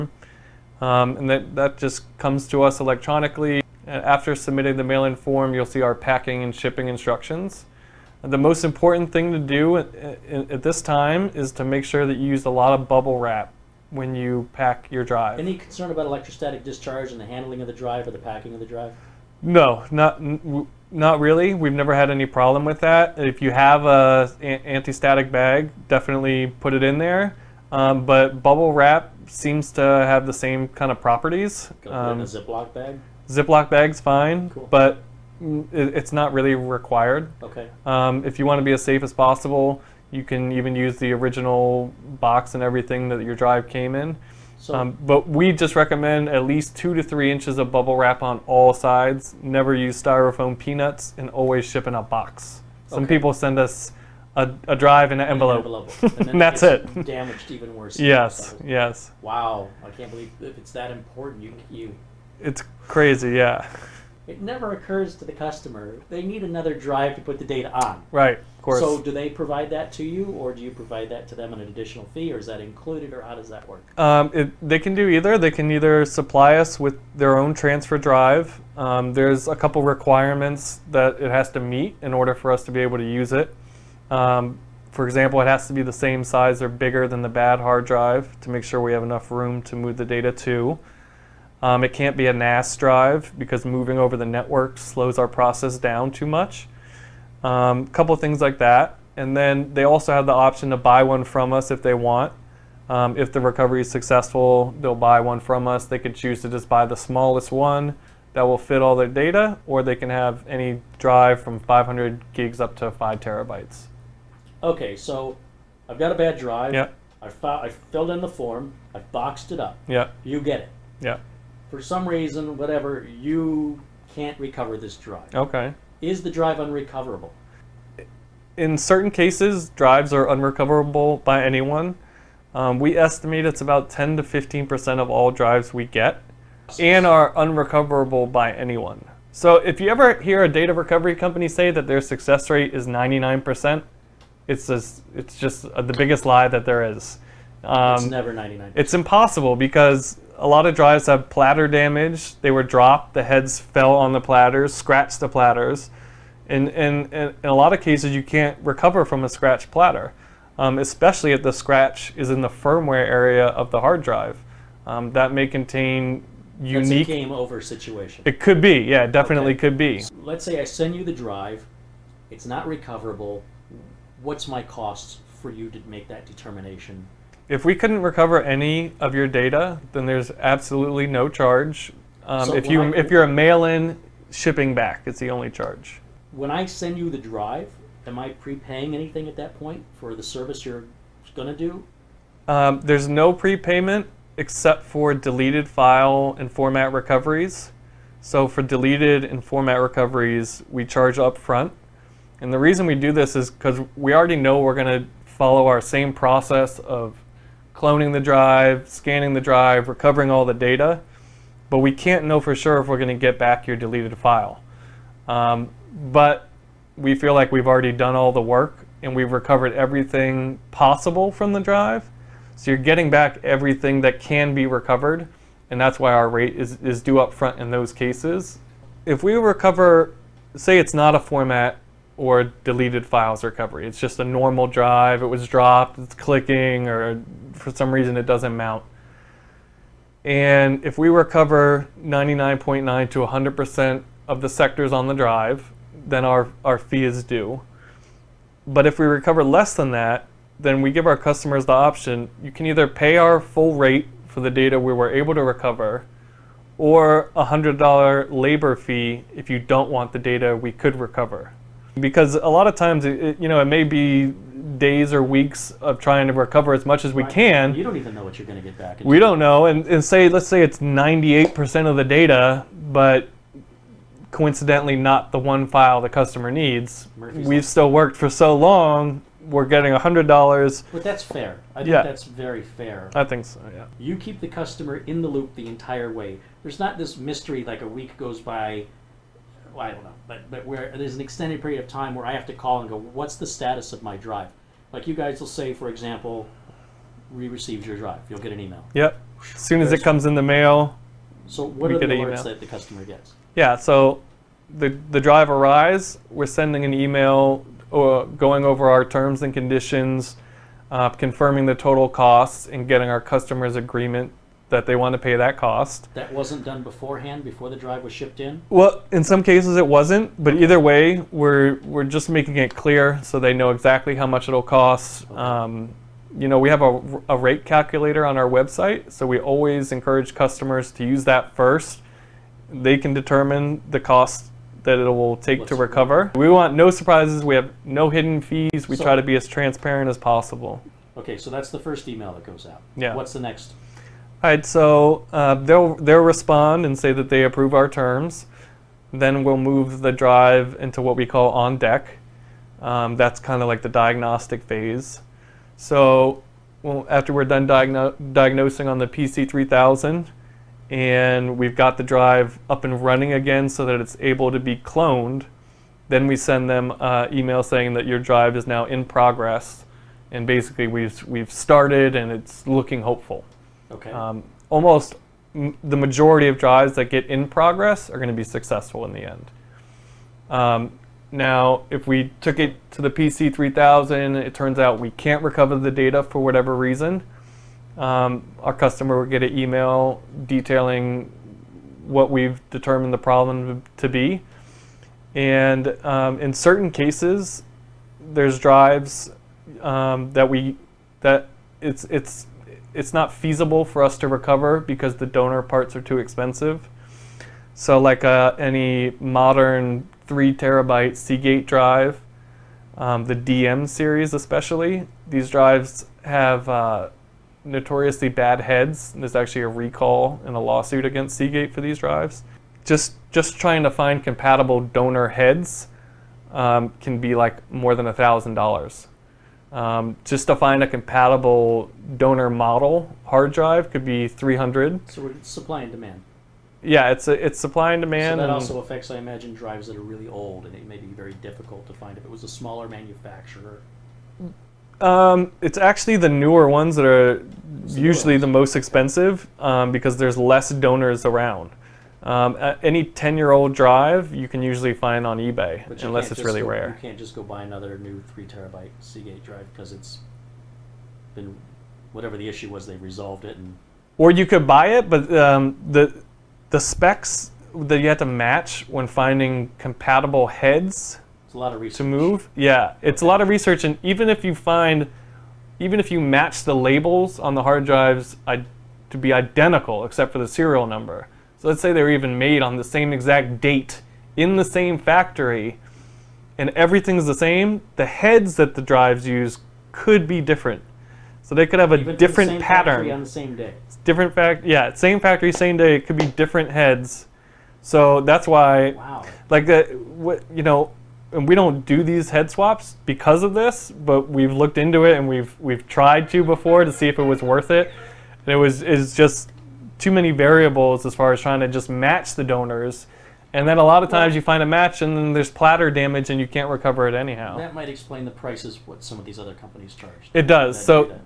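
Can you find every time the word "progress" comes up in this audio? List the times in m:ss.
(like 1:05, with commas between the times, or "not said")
6:09, 6:17.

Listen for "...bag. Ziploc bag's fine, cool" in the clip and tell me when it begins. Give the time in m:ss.
0:32.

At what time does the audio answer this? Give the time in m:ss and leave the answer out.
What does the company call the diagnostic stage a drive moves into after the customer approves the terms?
5:51.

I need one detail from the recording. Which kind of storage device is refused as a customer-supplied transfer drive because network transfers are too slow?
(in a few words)
NAS drive.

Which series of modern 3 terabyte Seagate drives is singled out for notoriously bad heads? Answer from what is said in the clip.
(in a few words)
DM series.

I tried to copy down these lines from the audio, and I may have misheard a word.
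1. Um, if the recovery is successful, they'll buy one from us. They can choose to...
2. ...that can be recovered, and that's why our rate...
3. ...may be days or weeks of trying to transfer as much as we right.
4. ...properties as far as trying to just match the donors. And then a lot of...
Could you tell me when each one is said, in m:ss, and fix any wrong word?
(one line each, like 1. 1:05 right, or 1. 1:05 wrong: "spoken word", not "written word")
1. 1:42 right
2. 3:44 right
3. 4:23 wrong: "recover", not "transfer"
4. 8:30 wrong: "variables", not "properties".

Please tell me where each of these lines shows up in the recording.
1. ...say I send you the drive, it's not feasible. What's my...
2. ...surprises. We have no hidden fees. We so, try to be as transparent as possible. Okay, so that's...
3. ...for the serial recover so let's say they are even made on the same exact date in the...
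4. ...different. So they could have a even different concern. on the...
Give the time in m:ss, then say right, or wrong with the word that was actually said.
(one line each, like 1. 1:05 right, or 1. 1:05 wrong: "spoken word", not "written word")
1. 2:50 wrong: "recoverable", not "feasible"
2. 5:36 right
3. 8:00 wrong: "number", not "recover"
4. 8:10 wrong: "pattern", not "concern".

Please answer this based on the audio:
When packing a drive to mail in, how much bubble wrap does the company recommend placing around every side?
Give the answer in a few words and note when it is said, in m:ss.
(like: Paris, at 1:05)
2 to 3 inches, at 0:46.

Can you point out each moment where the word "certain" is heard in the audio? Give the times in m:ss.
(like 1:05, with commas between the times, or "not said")
2:08, 6:36.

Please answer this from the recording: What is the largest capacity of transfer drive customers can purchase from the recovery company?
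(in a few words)
5 terabytes.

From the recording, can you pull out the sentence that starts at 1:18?
Um, there's a couple requirements that it has to meet in order for us to be able to use it.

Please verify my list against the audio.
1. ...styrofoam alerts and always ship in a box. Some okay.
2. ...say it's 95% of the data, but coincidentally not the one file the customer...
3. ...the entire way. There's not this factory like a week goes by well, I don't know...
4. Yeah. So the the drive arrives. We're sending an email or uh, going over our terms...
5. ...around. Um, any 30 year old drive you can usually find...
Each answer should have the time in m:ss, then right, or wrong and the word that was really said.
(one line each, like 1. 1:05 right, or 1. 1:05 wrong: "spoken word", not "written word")
1. 0:50 wrong: "peanuts", not "alerts"
2. 4:30 wrong: "98", not "95"
3. 4:45 wrong: "mystery", not "factory"
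4. 5:03 right
5. 7:31 wrong: "10", not "30".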